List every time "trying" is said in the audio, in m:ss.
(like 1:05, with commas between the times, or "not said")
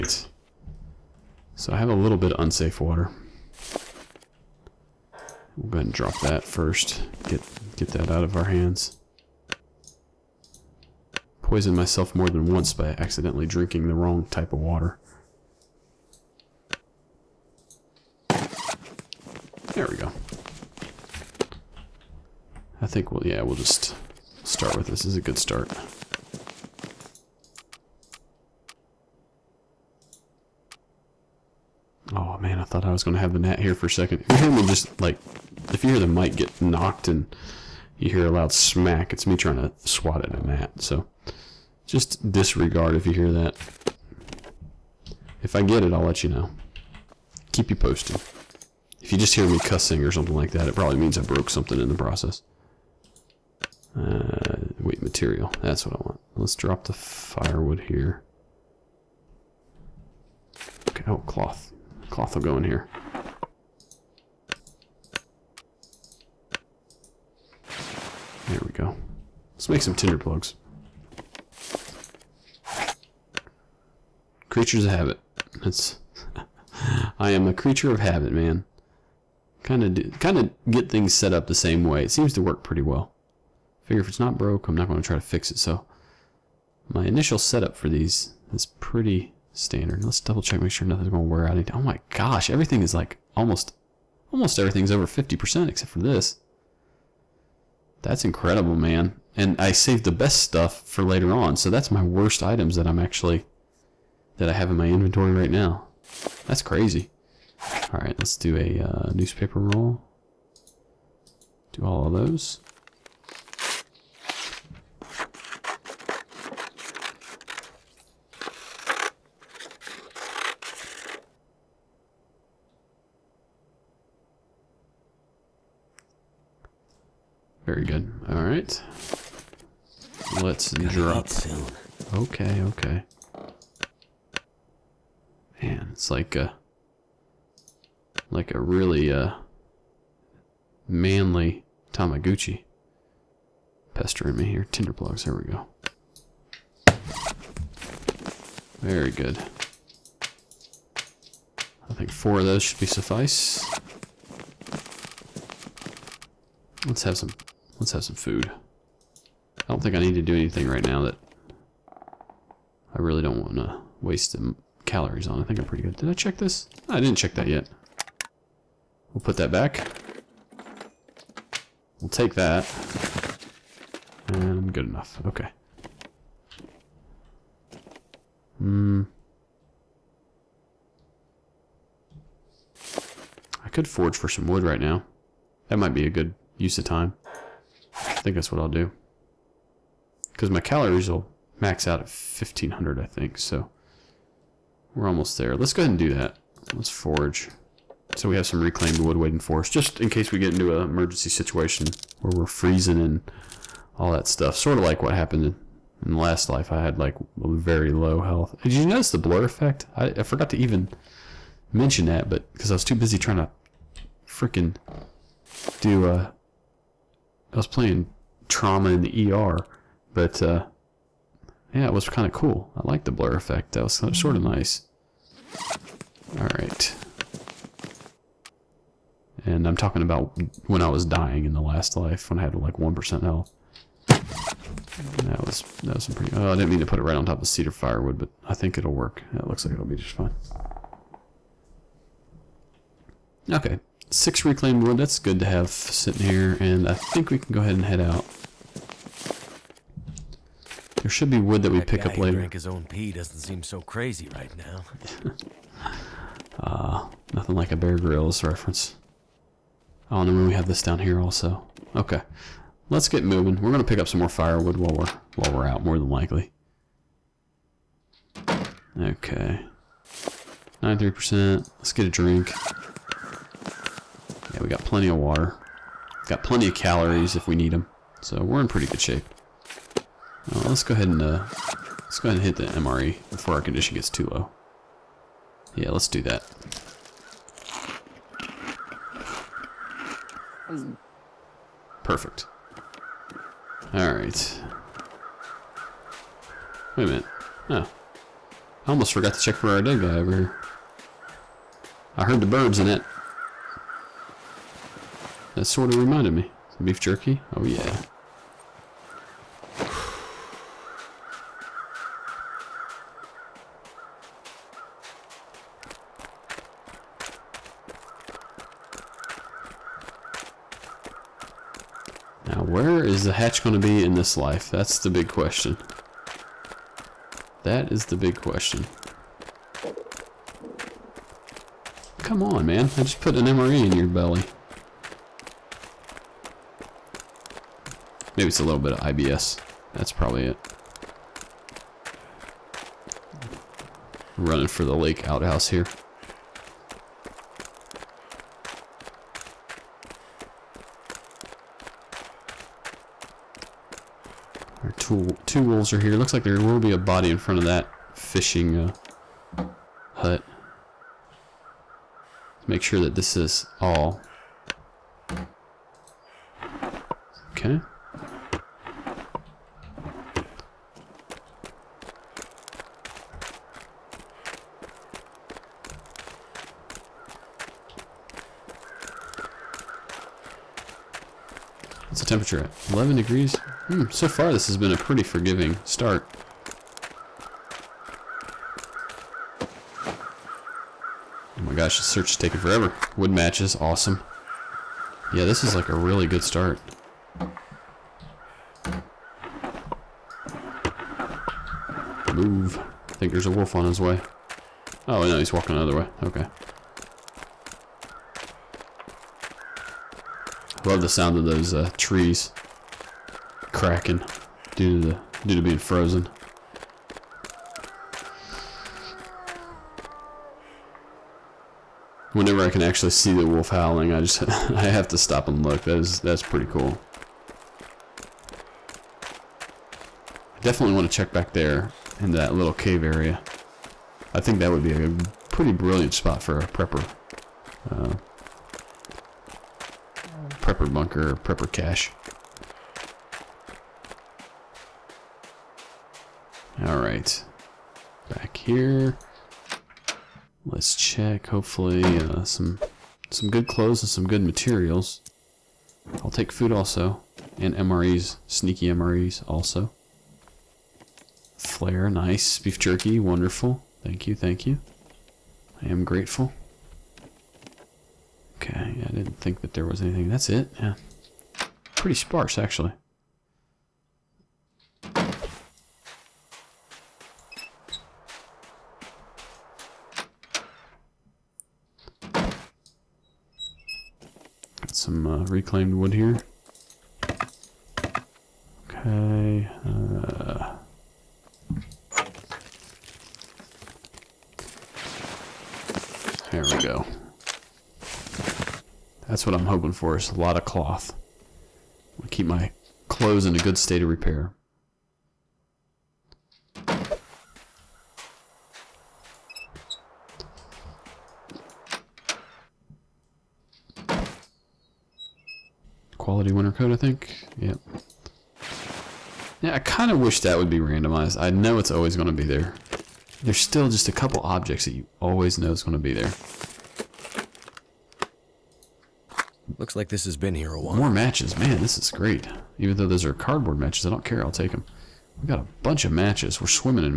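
0:39, 3:33.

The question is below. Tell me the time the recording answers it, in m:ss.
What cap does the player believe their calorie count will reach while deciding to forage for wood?
3:12.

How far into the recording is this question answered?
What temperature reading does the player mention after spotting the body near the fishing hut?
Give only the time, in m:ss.
6:22.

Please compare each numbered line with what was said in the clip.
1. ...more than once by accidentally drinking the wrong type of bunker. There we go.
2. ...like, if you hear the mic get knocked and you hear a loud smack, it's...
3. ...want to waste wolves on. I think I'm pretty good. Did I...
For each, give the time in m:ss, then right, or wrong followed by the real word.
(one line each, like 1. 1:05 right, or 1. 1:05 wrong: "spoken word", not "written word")
1. 0:12 wrong: "water", not "bunker"
2. 0:35 right
3. 2:43 wrong: "calories", not "wolves".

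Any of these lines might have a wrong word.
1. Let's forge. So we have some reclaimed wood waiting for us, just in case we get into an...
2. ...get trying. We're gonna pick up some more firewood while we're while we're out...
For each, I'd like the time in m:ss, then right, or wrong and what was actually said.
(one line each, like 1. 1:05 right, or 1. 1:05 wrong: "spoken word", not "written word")
1. 3:16 right
2. 4:23 wrong: "moving", not "trying".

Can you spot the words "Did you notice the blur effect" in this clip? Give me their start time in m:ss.
3:28.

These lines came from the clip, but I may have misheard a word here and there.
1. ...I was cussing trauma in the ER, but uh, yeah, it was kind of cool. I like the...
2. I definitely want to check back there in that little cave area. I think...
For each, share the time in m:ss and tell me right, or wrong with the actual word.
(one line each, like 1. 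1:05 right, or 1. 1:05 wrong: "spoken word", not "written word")
1. 3:37 wrong: "playing", not "cussing"
2. 7:10 right.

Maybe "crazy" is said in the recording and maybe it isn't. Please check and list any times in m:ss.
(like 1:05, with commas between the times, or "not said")
1:46, 4:13.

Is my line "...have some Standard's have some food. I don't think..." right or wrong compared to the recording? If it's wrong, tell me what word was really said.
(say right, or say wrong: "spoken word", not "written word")
wrong: "Let", not "Standard".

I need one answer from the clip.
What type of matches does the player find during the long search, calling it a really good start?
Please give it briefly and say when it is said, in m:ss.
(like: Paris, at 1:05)
wood matches, at 6:33.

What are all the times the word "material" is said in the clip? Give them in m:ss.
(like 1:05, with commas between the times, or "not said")
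0:55, 7:34.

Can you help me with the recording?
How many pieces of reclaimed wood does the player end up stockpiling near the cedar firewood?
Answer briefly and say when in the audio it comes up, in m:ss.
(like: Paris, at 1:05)
6, at 4:04.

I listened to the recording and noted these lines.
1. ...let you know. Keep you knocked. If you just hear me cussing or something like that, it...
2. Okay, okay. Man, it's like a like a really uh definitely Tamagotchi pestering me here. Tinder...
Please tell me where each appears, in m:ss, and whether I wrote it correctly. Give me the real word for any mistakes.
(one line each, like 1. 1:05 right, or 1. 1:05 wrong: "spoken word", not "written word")
1. 0:46 wrong: "posted", not "knocked"
2. 2:12 wrong: "manly", not "definitely".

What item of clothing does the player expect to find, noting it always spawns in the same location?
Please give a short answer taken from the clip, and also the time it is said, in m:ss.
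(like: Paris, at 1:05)
quality winter coat, at 8:36.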